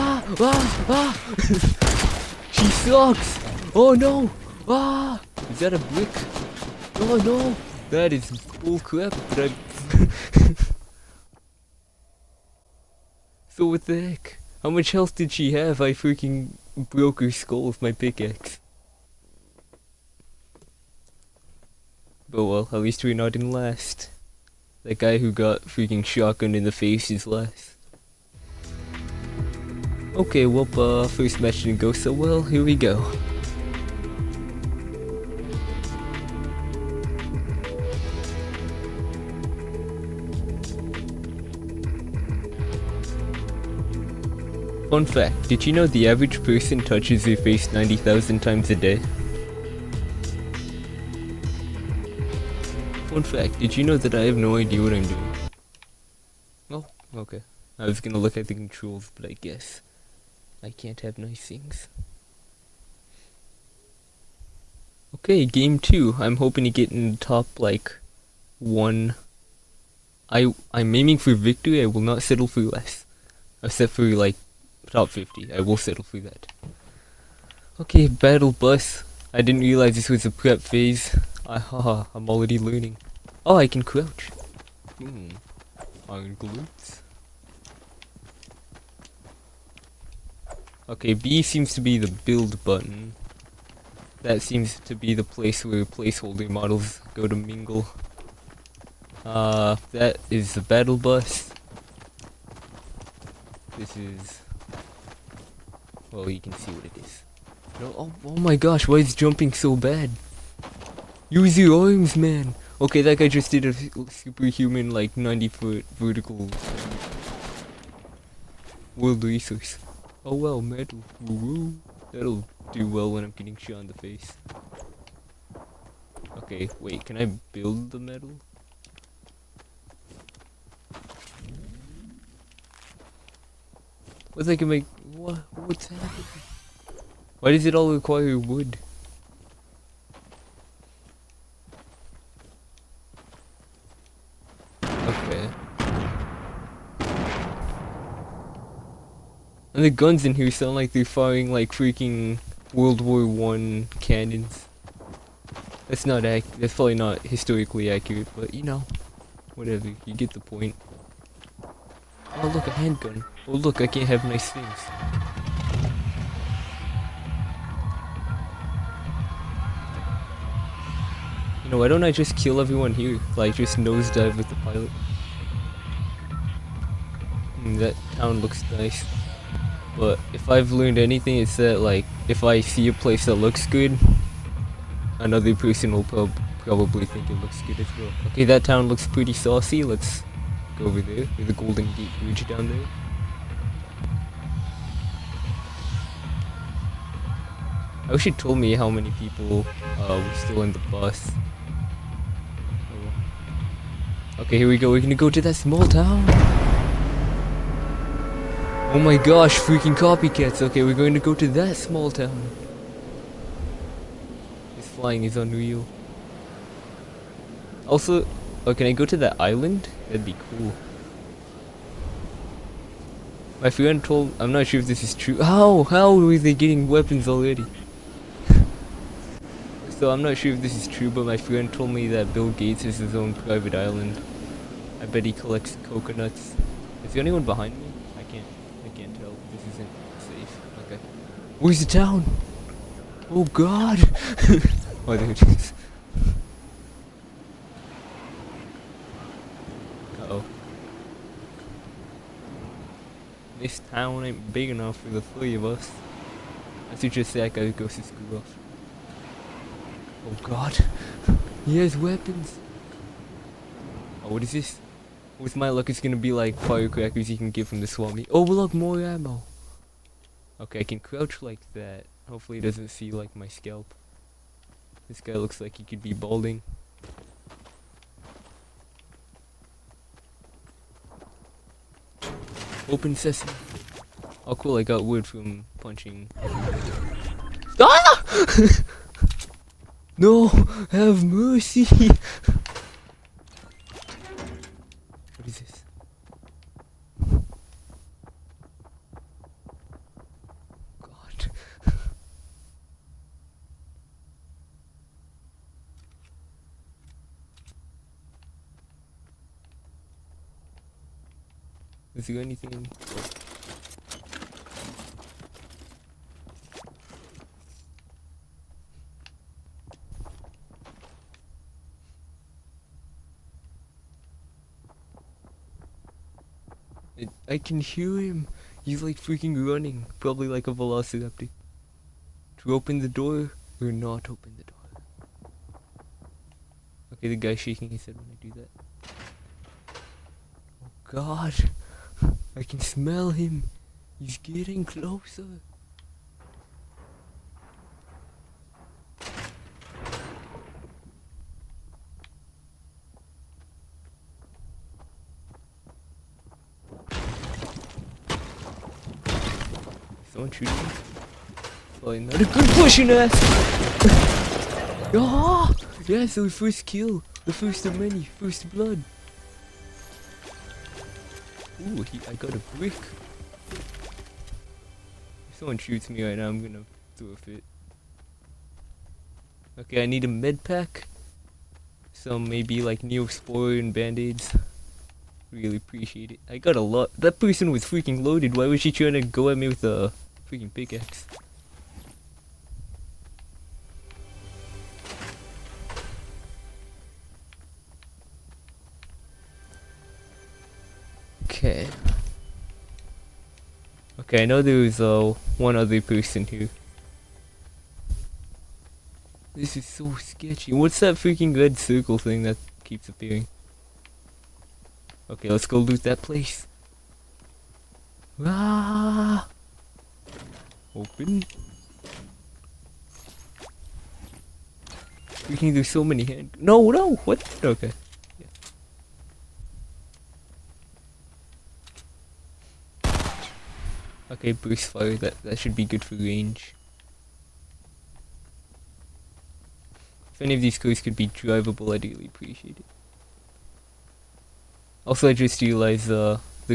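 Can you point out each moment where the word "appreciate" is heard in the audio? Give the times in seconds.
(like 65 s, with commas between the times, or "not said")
385 s, 442 s.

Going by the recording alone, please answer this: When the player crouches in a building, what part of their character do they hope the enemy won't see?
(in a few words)
scalp.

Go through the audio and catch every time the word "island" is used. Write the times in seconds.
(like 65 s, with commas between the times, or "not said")
219 s, 233 s.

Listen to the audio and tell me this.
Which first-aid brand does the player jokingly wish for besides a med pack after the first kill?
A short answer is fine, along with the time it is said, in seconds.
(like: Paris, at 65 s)
Neosporin, at 383 s.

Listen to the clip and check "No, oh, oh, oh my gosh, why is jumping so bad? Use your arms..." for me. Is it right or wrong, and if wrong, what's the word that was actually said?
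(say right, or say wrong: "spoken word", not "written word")
right.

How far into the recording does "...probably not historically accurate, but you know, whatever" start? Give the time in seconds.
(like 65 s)
156 s.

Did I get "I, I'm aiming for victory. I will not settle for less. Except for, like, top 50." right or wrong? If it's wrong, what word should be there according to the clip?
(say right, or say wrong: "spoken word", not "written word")
right.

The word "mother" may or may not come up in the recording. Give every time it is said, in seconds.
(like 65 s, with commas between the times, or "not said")
not said.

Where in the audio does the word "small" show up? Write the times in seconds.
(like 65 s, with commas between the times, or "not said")
205 s, 211 s.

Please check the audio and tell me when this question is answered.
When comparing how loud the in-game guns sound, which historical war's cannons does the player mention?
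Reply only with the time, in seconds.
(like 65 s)
152 s.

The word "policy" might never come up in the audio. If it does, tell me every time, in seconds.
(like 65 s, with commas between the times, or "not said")
not said.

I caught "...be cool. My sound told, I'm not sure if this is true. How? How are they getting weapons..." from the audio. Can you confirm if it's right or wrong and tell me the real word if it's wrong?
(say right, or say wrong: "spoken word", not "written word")
wrong: "friend", not "sound".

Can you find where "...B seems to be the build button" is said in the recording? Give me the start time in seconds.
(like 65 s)
91 s.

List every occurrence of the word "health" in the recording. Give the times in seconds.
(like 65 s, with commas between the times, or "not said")
14 s.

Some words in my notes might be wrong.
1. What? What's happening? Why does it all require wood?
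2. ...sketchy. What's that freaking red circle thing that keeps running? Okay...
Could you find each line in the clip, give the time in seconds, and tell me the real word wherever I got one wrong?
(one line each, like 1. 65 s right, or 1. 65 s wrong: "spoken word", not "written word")
1. 135 s right
2. 410 s wrong: "appearing", not "running".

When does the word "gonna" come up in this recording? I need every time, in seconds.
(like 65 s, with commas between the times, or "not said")
57 s, 205 s, 265 s, 376 s.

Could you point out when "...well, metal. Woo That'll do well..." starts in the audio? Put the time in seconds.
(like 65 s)
120 s.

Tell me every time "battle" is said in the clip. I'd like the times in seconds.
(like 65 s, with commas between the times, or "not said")
78 s, 100 s.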